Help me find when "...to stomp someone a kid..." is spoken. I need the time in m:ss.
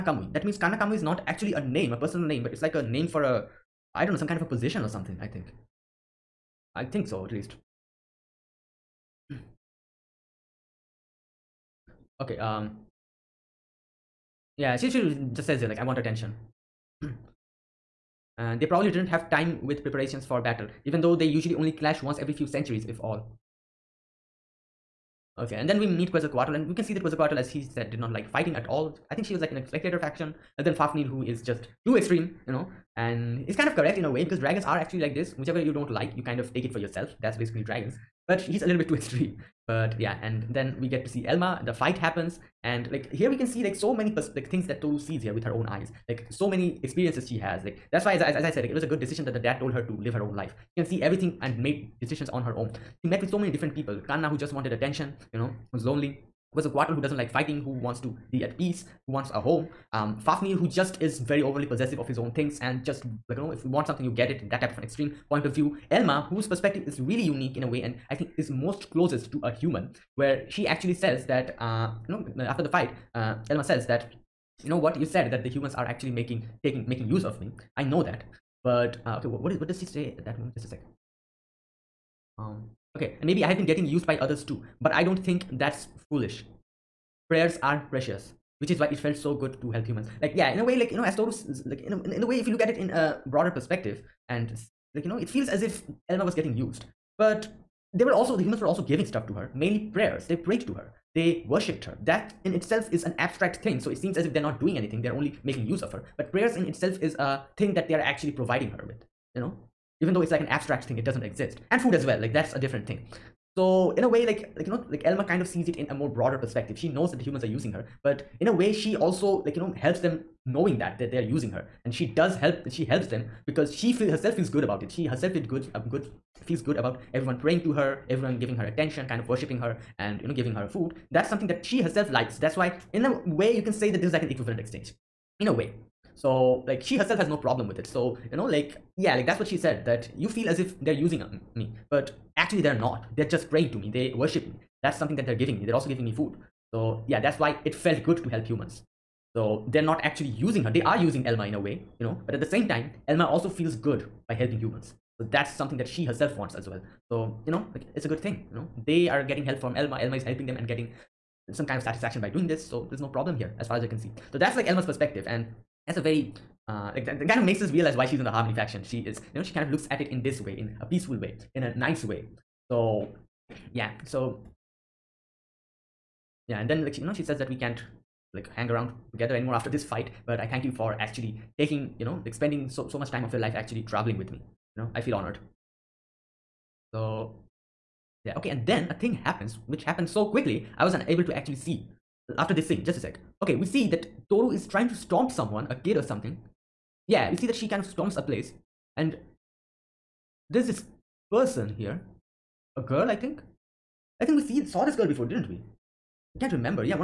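3:14.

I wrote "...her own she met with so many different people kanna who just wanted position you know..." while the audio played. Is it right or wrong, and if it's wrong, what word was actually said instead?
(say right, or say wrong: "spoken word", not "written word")
wrong: "attention", not "position".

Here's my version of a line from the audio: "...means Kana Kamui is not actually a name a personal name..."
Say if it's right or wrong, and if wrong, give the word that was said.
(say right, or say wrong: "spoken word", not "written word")
right.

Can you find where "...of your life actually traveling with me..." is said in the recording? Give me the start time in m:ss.
3:03.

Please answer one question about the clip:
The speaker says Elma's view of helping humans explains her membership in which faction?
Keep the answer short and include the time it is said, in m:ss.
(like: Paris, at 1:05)
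Harmony faction, at 2:48.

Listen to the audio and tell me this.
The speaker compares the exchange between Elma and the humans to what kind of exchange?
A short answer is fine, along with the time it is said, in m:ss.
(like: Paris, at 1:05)
Equivalent exchange, at 2:14.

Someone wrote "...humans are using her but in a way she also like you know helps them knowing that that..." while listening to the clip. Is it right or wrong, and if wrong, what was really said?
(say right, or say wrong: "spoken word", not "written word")
right.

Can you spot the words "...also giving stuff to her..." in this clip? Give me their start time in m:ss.
1:38.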